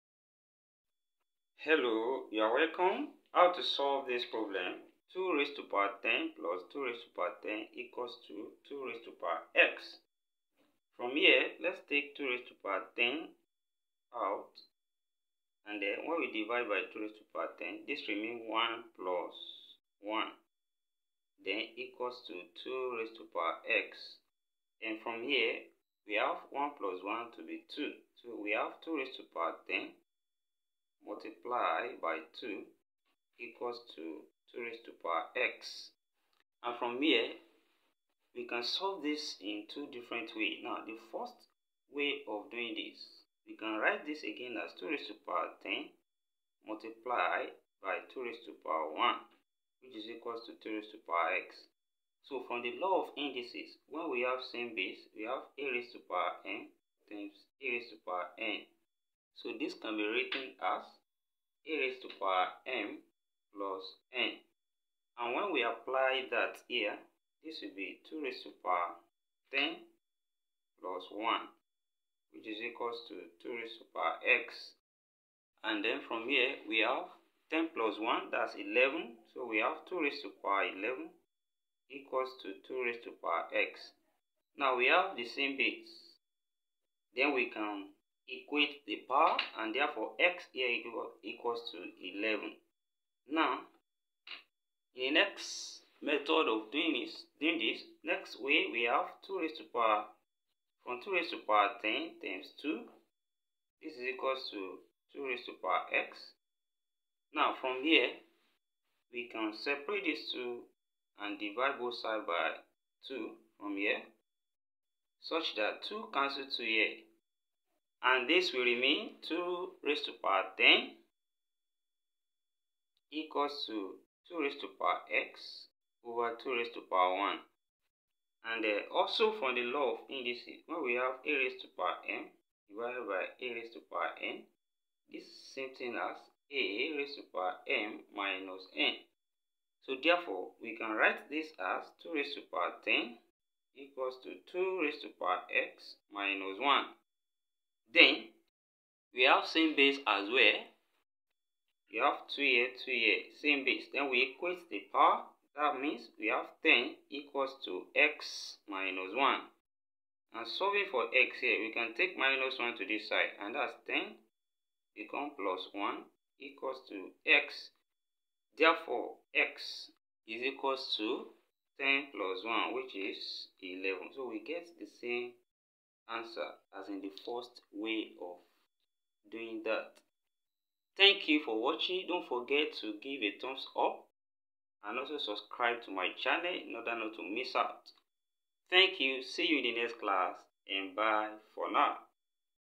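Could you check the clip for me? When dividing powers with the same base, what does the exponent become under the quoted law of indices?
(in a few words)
m minus n.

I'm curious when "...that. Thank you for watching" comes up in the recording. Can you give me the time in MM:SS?
02:59.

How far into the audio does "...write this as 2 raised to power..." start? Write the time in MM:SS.
02:20.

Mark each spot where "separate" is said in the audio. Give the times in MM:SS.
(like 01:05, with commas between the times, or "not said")
01:49.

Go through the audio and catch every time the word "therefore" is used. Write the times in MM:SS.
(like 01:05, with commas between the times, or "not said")
01:29, 02:20, 02:48.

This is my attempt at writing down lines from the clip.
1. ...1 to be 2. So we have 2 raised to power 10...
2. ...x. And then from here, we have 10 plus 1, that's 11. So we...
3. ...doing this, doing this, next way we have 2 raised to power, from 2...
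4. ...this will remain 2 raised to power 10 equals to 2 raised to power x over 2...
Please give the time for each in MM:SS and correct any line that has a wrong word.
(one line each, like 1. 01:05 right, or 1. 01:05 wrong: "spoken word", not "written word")
1. 00:27 right
2. 01:14 right
3. 01:36 right
4. 01:58 right.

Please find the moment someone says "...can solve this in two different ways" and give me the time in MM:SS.
00:38.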